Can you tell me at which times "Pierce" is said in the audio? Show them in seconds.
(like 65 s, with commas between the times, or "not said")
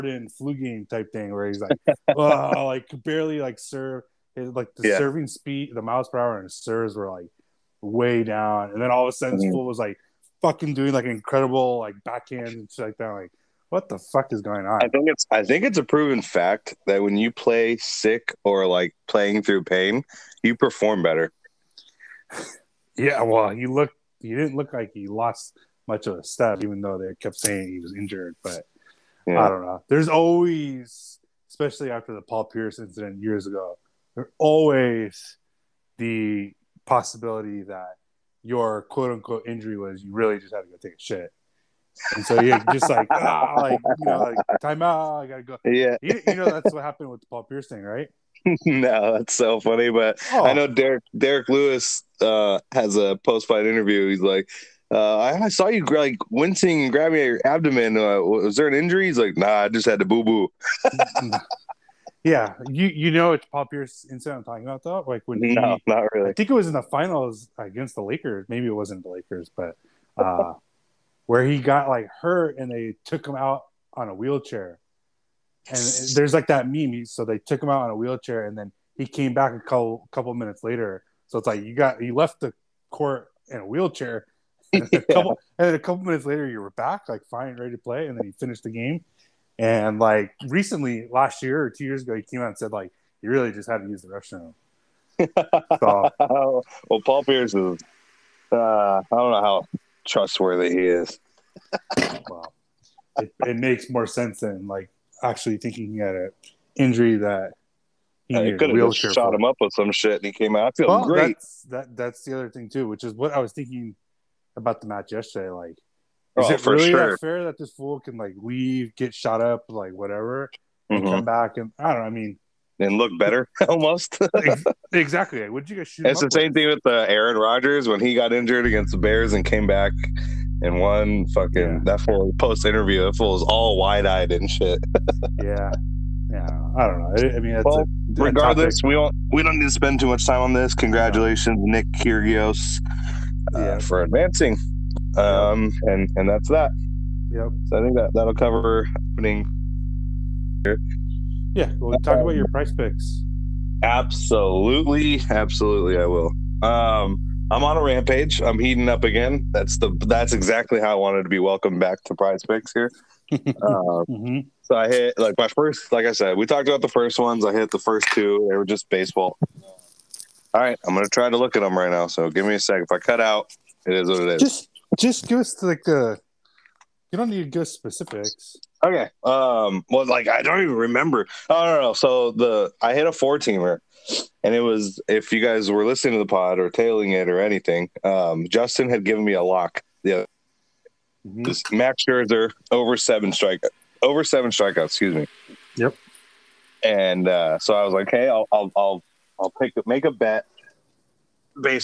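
32 s, 47 s, 63 s, 97 s.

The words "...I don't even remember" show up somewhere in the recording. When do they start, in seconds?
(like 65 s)
180 s.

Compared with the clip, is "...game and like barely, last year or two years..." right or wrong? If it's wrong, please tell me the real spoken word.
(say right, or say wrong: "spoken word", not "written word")
wrong: "recently", not "barely".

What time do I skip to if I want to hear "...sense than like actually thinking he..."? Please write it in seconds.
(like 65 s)
104 s.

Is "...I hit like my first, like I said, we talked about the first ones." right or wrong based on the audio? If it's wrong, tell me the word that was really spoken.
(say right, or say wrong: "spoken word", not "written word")
right.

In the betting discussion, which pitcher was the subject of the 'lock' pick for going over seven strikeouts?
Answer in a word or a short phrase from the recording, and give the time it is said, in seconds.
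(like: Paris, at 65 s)
Max Scherzer, at 191 s.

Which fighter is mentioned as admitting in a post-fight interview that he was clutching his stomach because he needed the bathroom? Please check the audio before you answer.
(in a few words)
Derrick Lewis.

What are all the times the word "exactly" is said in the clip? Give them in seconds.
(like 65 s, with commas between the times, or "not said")
124 s, 160 s.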